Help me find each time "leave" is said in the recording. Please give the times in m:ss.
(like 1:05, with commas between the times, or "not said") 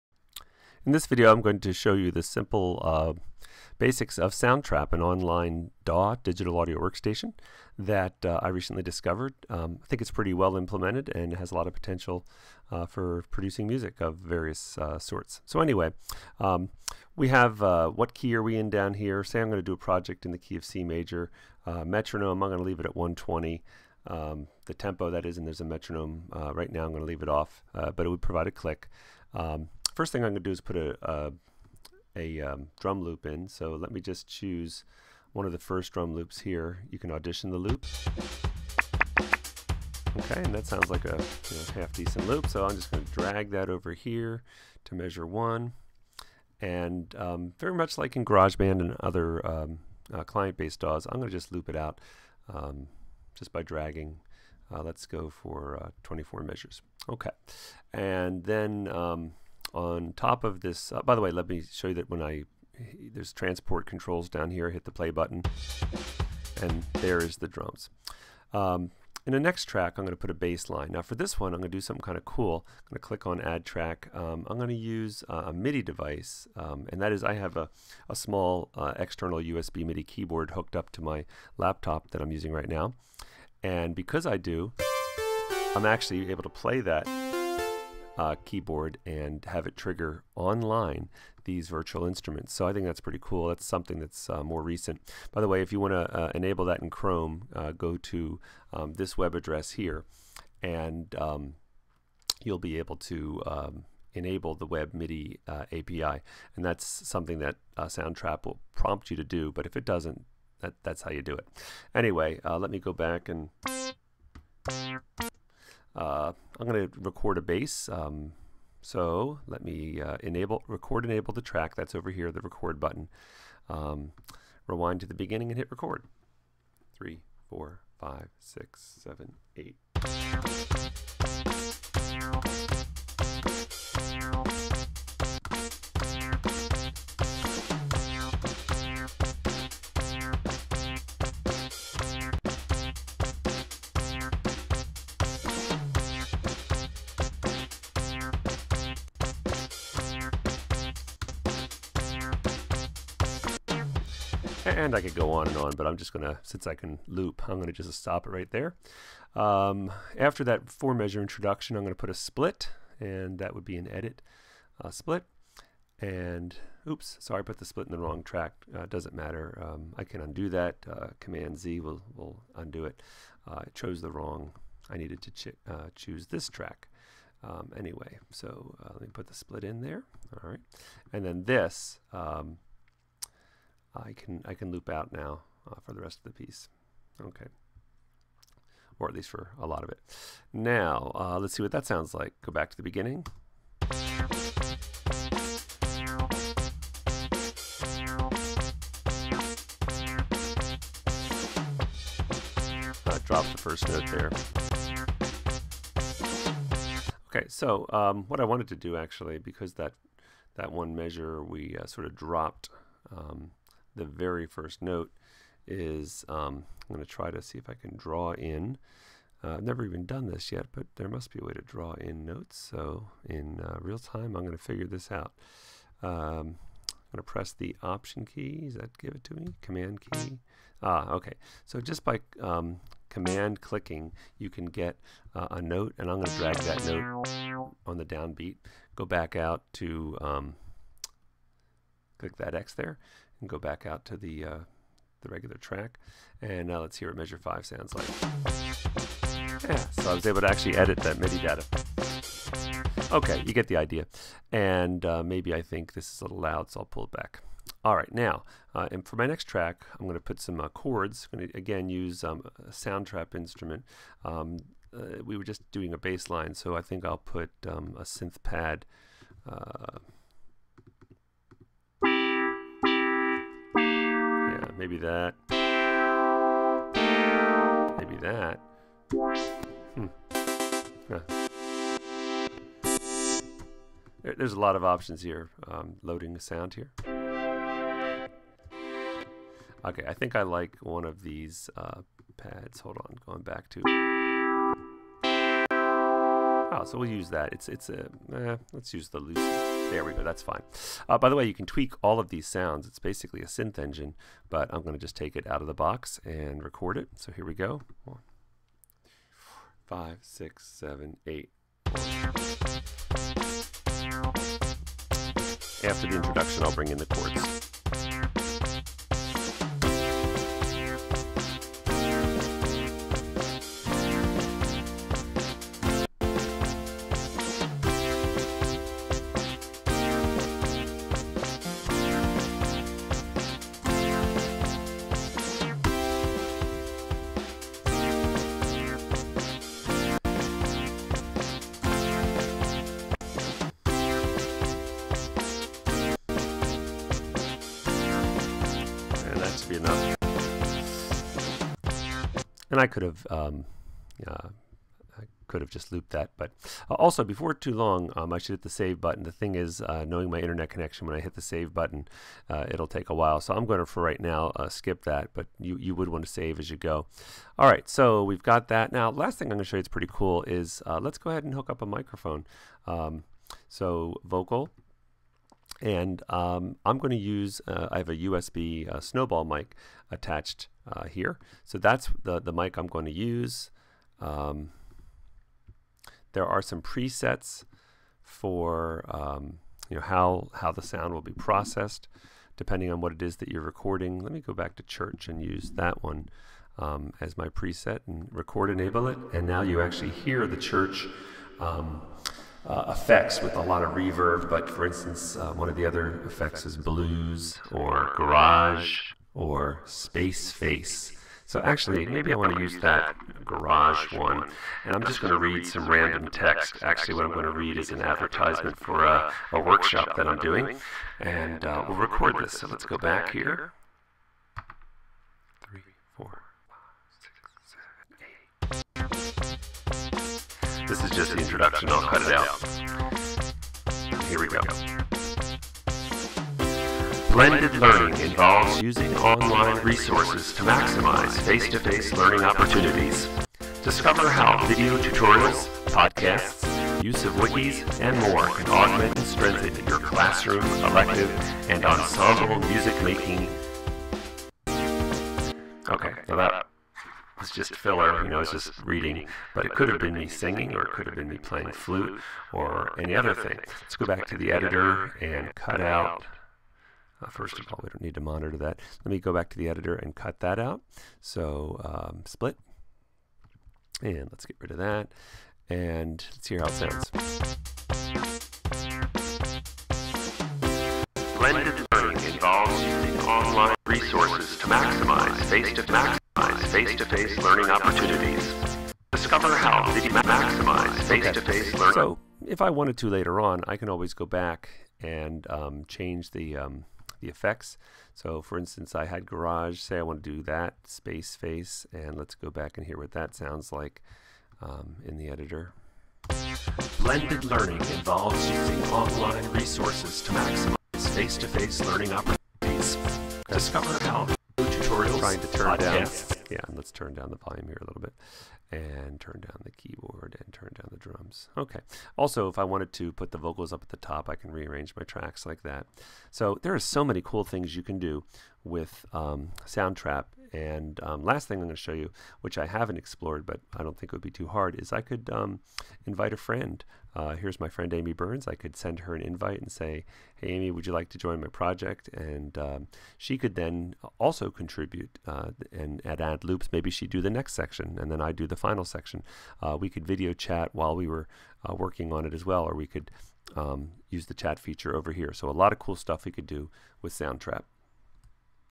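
0:22, 0:27.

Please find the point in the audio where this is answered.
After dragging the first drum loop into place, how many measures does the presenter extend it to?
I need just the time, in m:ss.
0:56.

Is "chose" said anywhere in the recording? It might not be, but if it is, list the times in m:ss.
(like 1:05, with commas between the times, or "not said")
2:53.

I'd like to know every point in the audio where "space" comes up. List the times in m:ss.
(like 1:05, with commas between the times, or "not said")
6:49, 8:20.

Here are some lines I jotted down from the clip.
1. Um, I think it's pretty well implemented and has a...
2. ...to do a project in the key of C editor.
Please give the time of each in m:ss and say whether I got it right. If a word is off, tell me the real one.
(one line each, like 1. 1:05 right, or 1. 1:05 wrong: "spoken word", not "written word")
1. 0:09 right
2. 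0:19 wrong: "major", not "editor".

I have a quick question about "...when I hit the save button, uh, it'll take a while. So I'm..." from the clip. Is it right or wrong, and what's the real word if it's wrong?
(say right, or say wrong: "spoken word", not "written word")
right.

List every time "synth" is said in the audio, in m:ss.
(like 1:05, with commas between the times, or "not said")
4:28, 5:03.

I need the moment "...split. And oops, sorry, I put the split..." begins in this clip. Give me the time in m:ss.
2:44.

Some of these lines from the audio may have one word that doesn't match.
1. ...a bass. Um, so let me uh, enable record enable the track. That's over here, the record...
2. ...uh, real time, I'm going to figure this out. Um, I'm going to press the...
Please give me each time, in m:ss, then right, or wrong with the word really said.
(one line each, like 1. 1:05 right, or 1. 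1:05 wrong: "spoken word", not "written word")
1. 1:57 right
2. 3:43 right.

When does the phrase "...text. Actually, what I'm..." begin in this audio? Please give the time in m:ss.
6:56.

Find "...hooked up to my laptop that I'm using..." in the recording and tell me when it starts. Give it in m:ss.
1:20.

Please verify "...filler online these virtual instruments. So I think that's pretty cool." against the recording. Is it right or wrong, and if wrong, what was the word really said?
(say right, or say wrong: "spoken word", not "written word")
wrong: "trigger", not "filler".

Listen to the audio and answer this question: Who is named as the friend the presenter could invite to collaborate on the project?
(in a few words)
Amy Burns.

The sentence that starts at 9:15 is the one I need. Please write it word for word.
So a lot of cool stuff we could do with Soundtrap.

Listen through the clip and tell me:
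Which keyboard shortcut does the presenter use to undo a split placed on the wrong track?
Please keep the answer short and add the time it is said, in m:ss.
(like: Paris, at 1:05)
Command Z, at 2:51.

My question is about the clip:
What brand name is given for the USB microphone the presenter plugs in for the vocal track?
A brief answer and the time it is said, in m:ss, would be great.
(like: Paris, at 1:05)
Snowball, at 6:18.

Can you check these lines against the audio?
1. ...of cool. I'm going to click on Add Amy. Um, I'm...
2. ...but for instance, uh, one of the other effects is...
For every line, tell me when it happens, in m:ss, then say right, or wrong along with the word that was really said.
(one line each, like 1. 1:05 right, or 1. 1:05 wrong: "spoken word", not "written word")
1. 1:12 wrong: "Track", not "Amy"
2. 6:44 right.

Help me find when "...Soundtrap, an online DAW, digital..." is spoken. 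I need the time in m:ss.
0:04.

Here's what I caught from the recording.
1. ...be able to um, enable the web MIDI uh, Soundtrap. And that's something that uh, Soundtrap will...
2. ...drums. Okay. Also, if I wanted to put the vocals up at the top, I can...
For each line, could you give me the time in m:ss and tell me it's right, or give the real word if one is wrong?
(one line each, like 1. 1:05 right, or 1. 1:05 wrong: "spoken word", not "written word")
1. 1:42 wrong: "API", not "Soundtrap"
2. 8:40 right.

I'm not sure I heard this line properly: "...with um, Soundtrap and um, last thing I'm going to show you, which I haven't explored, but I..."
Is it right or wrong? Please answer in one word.
right.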